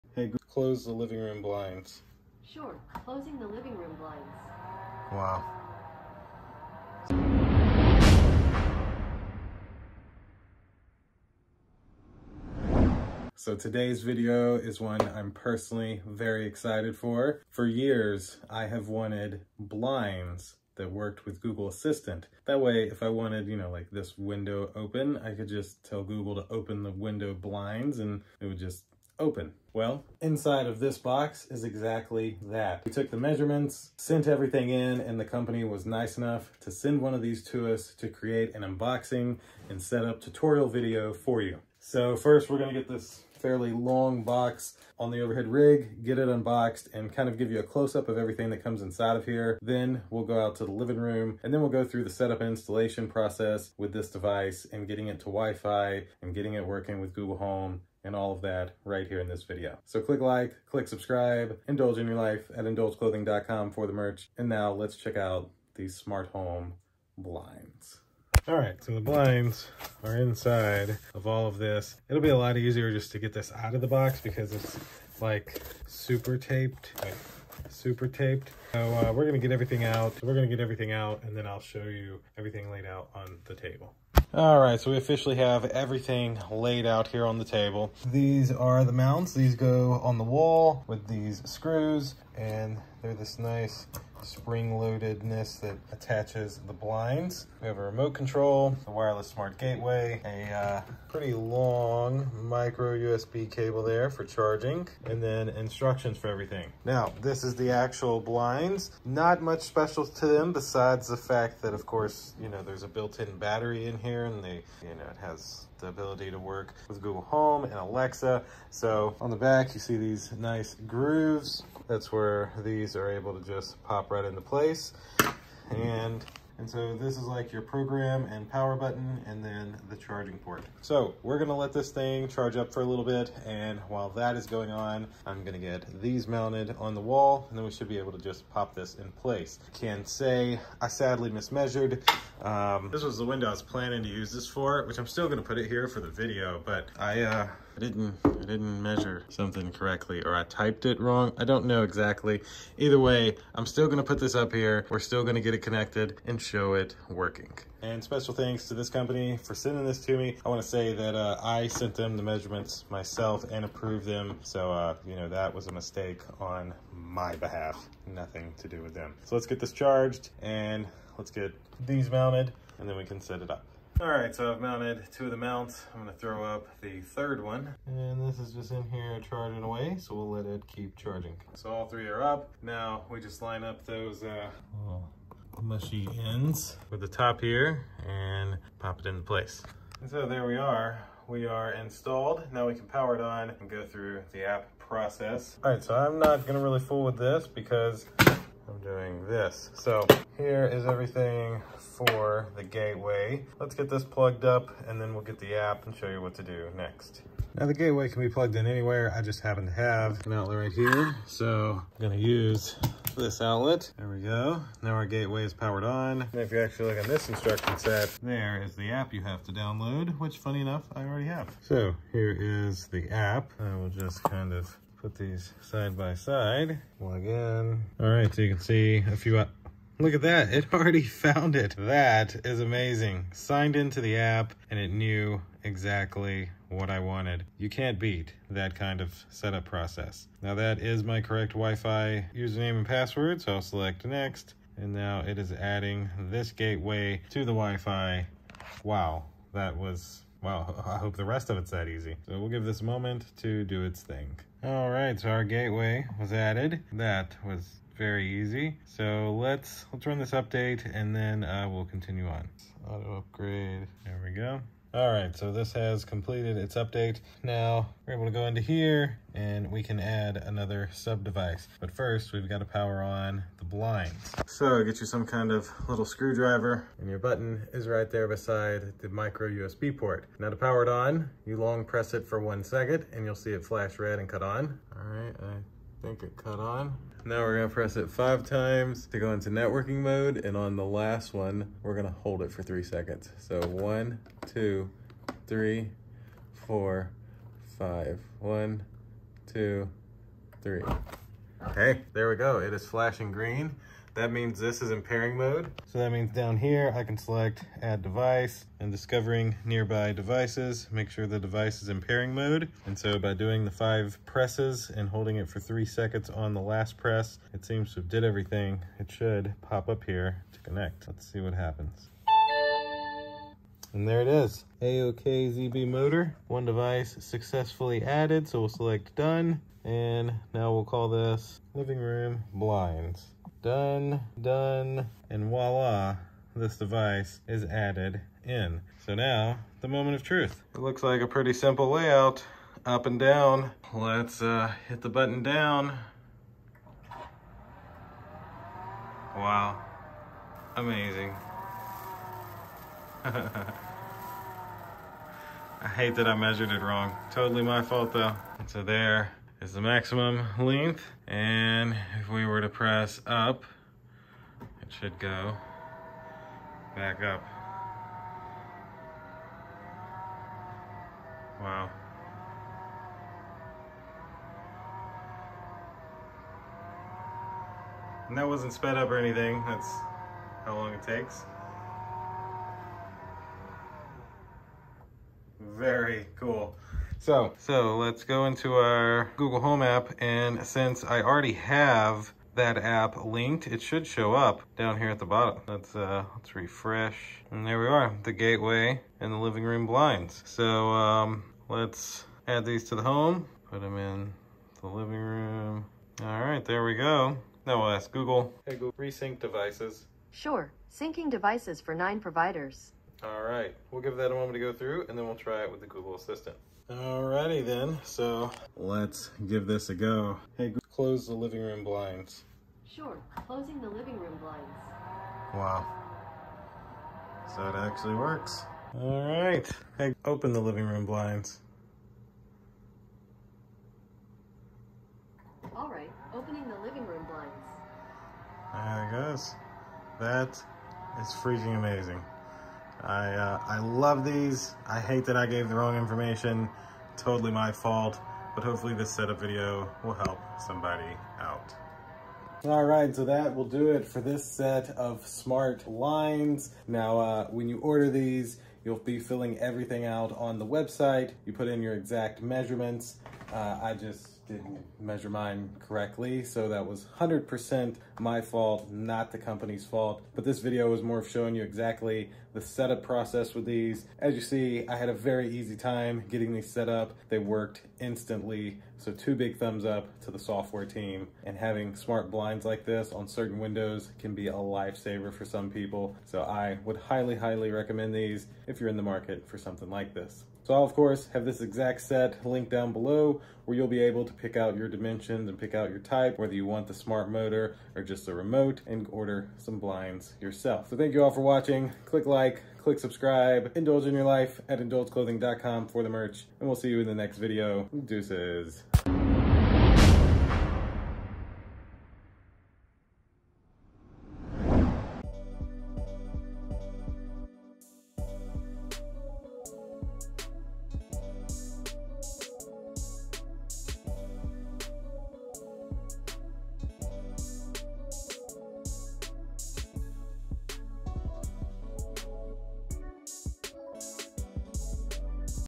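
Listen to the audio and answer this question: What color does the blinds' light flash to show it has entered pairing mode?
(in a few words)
green.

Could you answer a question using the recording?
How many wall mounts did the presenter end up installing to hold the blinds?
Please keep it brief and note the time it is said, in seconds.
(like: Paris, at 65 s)
3, at 177 s.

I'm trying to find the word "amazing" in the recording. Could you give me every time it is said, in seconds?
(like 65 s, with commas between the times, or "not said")
232 s, 350 s, 441 s.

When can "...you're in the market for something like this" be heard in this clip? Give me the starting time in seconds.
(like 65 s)
488 s.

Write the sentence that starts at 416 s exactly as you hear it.
Alrighty then, so let's give this a go.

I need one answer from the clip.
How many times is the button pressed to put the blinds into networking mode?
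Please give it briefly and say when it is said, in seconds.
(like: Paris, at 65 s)
5, at 288 s.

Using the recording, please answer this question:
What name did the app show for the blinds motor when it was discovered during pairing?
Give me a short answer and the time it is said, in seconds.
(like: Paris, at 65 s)
AOK ZB motor, at 324 s.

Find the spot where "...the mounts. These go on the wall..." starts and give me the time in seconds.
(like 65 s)
88 s.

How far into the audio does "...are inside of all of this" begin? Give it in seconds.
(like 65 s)
70 s.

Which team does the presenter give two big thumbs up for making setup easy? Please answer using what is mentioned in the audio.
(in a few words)
software team.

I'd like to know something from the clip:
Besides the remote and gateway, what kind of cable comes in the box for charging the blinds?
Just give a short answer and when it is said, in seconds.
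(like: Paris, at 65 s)
micro USB cable, at 102 s.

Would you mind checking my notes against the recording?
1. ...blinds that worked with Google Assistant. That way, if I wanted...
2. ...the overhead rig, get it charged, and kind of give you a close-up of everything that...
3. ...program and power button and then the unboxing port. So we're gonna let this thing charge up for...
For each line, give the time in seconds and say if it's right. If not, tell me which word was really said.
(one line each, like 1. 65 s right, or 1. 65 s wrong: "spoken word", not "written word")
1. 19 s right
2. 45 s wrong: "unboxed", not "charged"
3. 127 s wrong: "charging", not "unboxing".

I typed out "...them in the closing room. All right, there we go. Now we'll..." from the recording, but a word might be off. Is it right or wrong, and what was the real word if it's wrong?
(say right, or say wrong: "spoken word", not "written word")
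wrong: "living", not "closing".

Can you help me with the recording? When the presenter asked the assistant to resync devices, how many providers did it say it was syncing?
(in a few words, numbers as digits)
9.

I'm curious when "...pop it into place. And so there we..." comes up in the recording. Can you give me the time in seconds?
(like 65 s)
188 s.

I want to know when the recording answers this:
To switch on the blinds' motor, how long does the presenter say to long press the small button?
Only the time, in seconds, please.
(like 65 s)
282 s.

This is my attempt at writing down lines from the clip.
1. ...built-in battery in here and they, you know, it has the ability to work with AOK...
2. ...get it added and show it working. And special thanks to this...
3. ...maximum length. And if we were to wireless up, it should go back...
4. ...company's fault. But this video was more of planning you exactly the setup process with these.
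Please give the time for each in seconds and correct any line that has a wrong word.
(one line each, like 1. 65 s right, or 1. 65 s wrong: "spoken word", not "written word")
1. 112 s wrong: "Google", not "AOK"
2. 155 s wrong: "connected", not "added"
3. 359 s wrong: "press", not "wireless"
4. 469 s wrong: "showing", not "planning".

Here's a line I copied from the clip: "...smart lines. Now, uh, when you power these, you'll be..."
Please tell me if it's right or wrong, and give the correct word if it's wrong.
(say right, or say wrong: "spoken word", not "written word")
wrong: "order", not "power".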